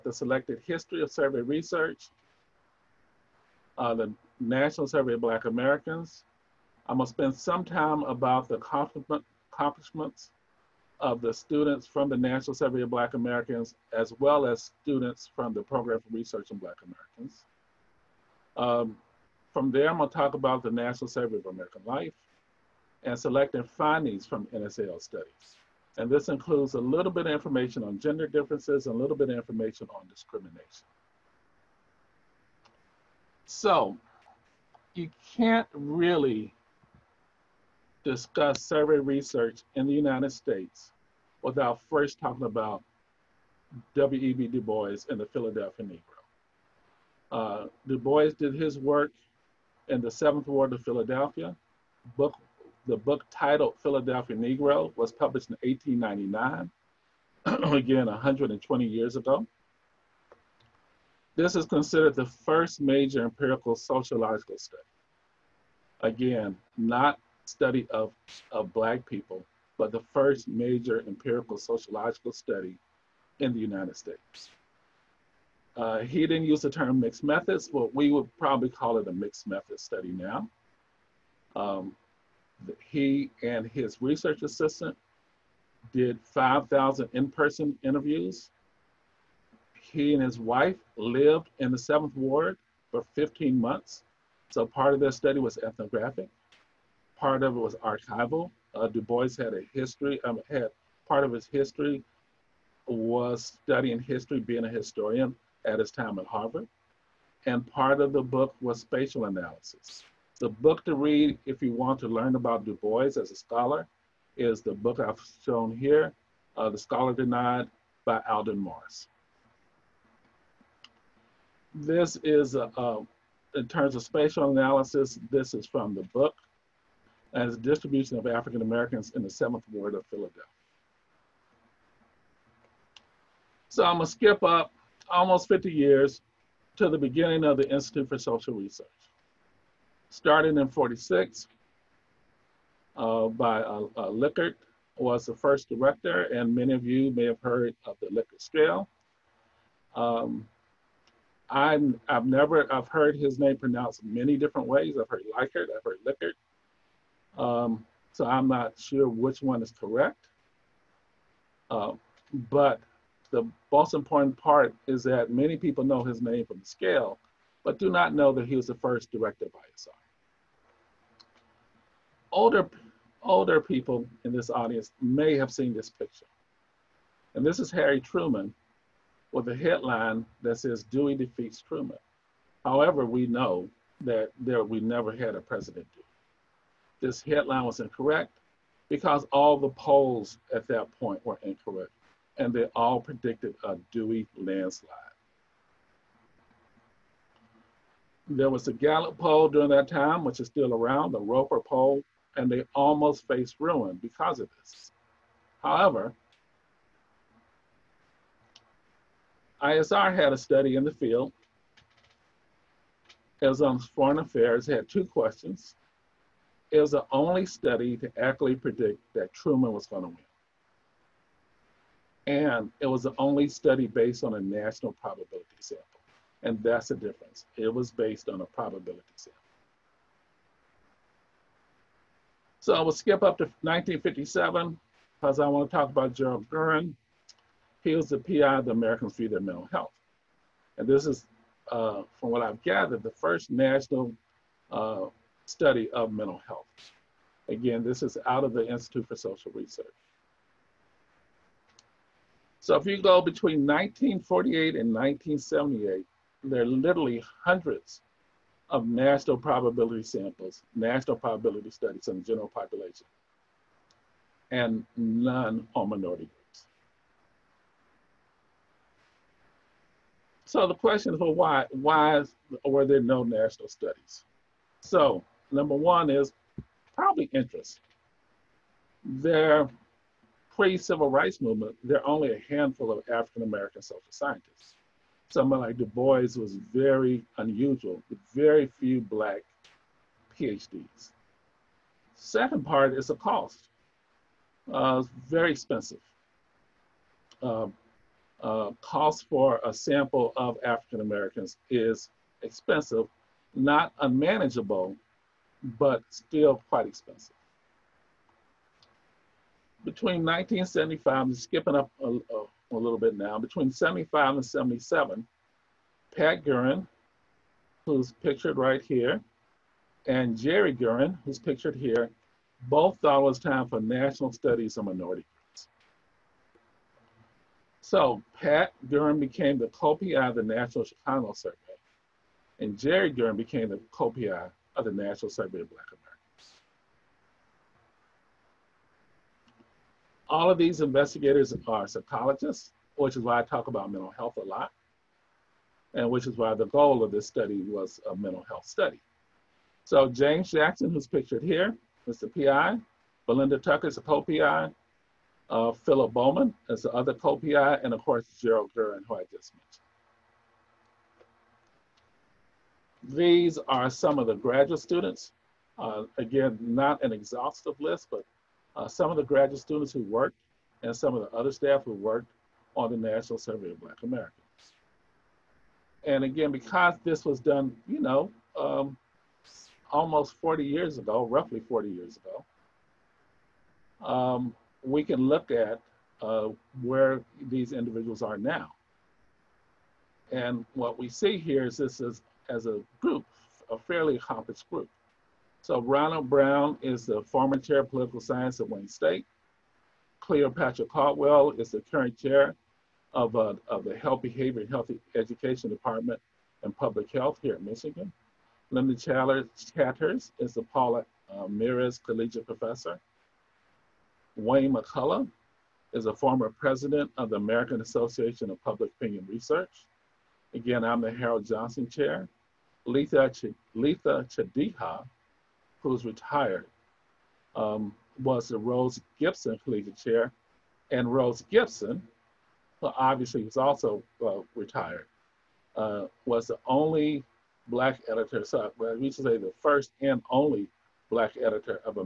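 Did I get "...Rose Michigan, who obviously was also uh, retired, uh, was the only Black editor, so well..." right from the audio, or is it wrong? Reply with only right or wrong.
wrong.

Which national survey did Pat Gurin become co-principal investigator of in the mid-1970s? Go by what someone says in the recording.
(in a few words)
National Chicano Survey.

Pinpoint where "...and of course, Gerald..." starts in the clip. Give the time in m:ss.
5:57.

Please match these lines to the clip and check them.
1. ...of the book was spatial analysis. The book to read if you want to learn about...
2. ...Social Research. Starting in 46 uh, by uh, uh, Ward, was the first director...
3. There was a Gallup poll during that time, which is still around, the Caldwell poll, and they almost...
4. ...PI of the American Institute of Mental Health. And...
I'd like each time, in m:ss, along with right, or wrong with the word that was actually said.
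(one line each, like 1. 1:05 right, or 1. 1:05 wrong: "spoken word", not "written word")
1. 1:47 right
2. 2:18 wrong: "Lickert", not "Ward"
3. 3:18 wrong: "Roper", not "Caldwell"
4. 3:58 right.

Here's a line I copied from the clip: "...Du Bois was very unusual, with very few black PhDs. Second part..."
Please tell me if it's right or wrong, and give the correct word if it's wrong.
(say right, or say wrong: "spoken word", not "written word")
right.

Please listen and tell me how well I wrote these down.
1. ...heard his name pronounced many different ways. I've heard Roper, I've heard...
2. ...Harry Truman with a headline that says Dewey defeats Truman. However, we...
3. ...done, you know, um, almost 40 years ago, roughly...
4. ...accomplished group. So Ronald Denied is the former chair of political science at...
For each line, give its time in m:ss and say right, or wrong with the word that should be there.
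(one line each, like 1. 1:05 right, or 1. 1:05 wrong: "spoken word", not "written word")
1. 2:32 wrong: "Likert", not "Roper"
2. 2:57 right
3. 6:17 right
4. 6:34 wrong: "Brown", not "Denied".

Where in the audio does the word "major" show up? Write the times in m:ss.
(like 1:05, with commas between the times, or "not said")
1:02, 1:10.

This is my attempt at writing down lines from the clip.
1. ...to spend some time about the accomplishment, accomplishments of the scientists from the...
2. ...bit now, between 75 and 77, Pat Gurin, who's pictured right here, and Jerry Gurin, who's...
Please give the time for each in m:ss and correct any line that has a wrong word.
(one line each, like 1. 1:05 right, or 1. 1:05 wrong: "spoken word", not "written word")
1. 0:07 wrong: "students", not "scientists"
2. 5:12 right.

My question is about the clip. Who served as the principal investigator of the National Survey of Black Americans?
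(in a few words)
James Jackson.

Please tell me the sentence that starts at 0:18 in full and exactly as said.
Um, from there, I'm gonna talk about the National Survey of American Life and selecting findings from NSAL studies.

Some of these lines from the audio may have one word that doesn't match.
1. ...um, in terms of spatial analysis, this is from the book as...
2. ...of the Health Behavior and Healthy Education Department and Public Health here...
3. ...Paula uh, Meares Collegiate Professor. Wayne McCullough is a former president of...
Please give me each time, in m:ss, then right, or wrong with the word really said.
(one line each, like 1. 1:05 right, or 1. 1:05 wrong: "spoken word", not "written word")
1. 2:02 right
2. 6:43 right
3. 6:50 right.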